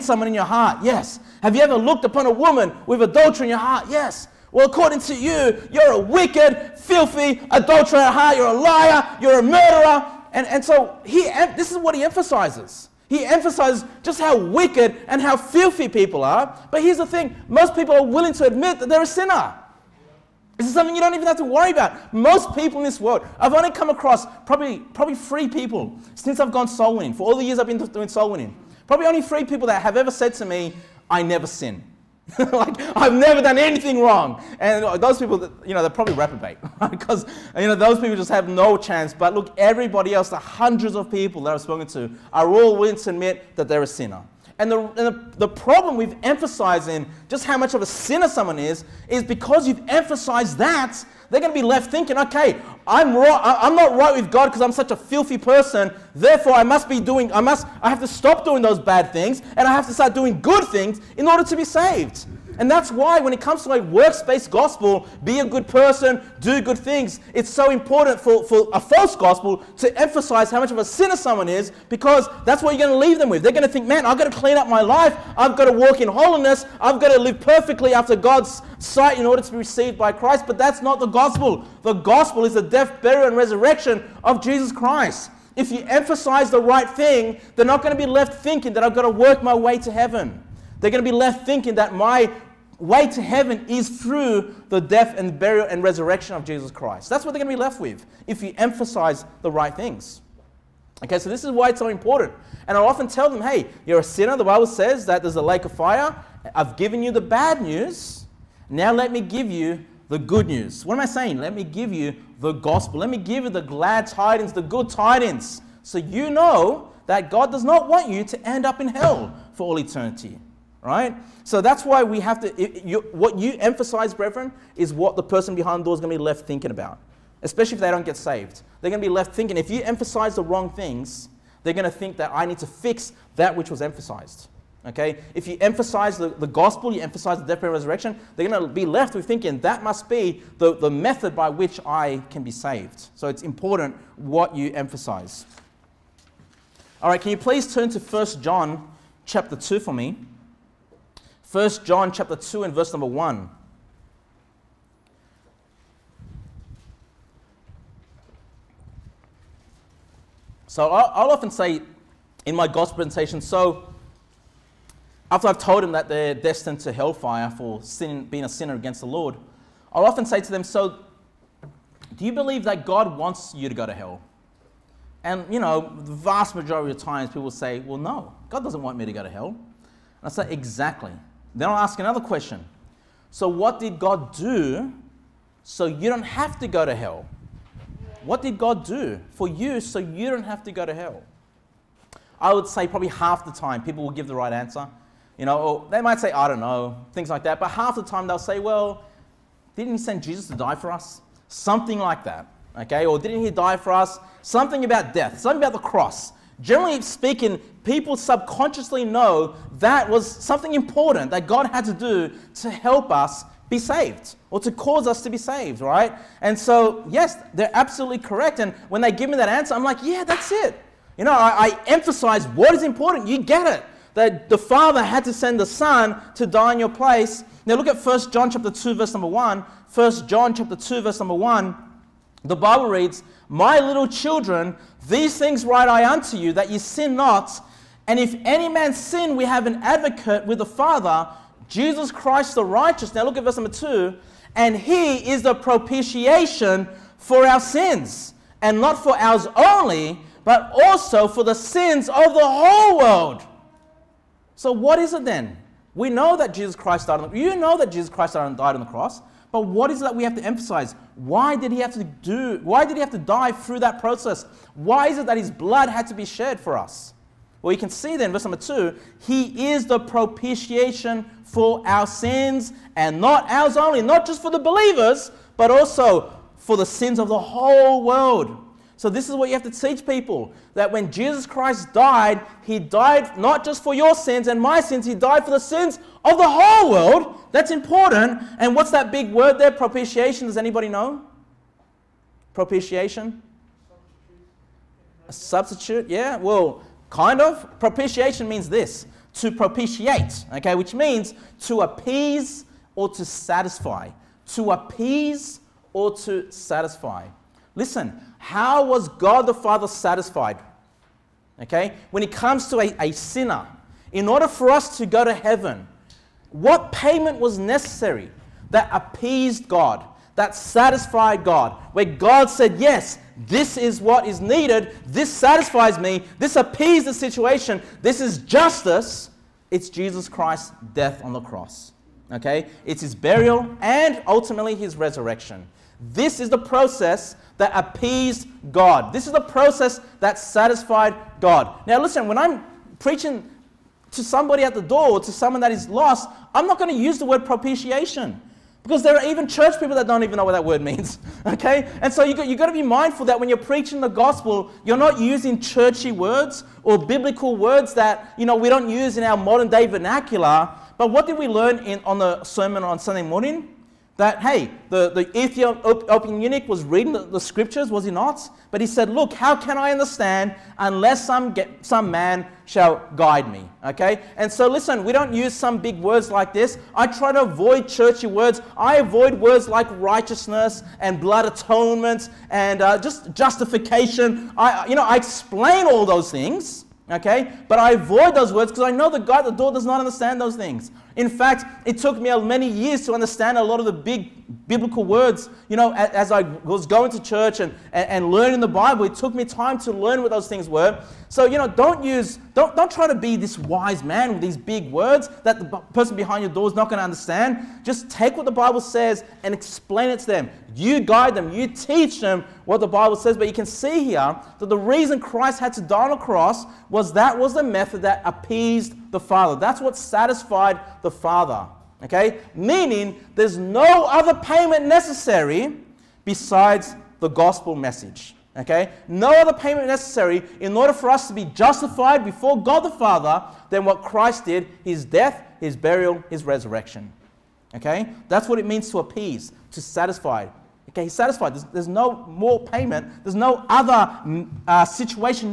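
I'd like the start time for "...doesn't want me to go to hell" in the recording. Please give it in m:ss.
2:58.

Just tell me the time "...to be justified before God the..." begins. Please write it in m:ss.
7:11.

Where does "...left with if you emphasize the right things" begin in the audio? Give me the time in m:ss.
1:37.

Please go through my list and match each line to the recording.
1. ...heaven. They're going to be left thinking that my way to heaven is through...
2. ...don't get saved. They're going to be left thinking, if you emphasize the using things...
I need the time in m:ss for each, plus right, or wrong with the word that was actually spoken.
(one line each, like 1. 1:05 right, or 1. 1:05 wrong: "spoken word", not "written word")
1. 1:29 right
2. 2:07 wrong: "wrong", not "using".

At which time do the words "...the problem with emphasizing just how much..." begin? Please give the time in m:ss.
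0:45.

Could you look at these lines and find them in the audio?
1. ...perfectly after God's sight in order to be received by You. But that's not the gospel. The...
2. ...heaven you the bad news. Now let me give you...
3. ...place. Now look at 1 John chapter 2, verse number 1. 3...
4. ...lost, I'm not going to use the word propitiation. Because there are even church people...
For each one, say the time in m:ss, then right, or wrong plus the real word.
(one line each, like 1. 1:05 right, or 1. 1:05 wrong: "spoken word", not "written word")
1. 1:17 wrong: "Christ", not "You"
2. 1:46 wrong: "given", not "heaven"
3. 3:46 wrong: "1", not "3"
4. 5:45 right.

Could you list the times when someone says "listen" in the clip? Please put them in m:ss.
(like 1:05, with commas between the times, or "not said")
5:07, 5:41, 6:14.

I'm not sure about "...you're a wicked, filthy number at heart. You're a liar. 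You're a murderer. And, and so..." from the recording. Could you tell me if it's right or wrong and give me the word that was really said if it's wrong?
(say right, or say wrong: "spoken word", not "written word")
wrong: "adulterer", not "number".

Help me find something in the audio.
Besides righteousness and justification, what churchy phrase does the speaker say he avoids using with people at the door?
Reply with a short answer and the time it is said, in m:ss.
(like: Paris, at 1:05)
blood atonement, at 6:21.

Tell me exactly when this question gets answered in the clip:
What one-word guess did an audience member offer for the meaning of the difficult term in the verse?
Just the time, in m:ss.
4:55.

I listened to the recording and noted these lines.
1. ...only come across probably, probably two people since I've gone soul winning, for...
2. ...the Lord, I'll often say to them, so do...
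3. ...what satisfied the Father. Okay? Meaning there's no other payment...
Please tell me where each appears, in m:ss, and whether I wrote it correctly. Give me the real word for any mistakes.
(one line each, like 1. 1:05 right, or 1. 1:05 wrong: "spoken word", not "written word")
1. 0:23 wrong: "three", not "two"
2. 2:48 right
3. 6:59 right.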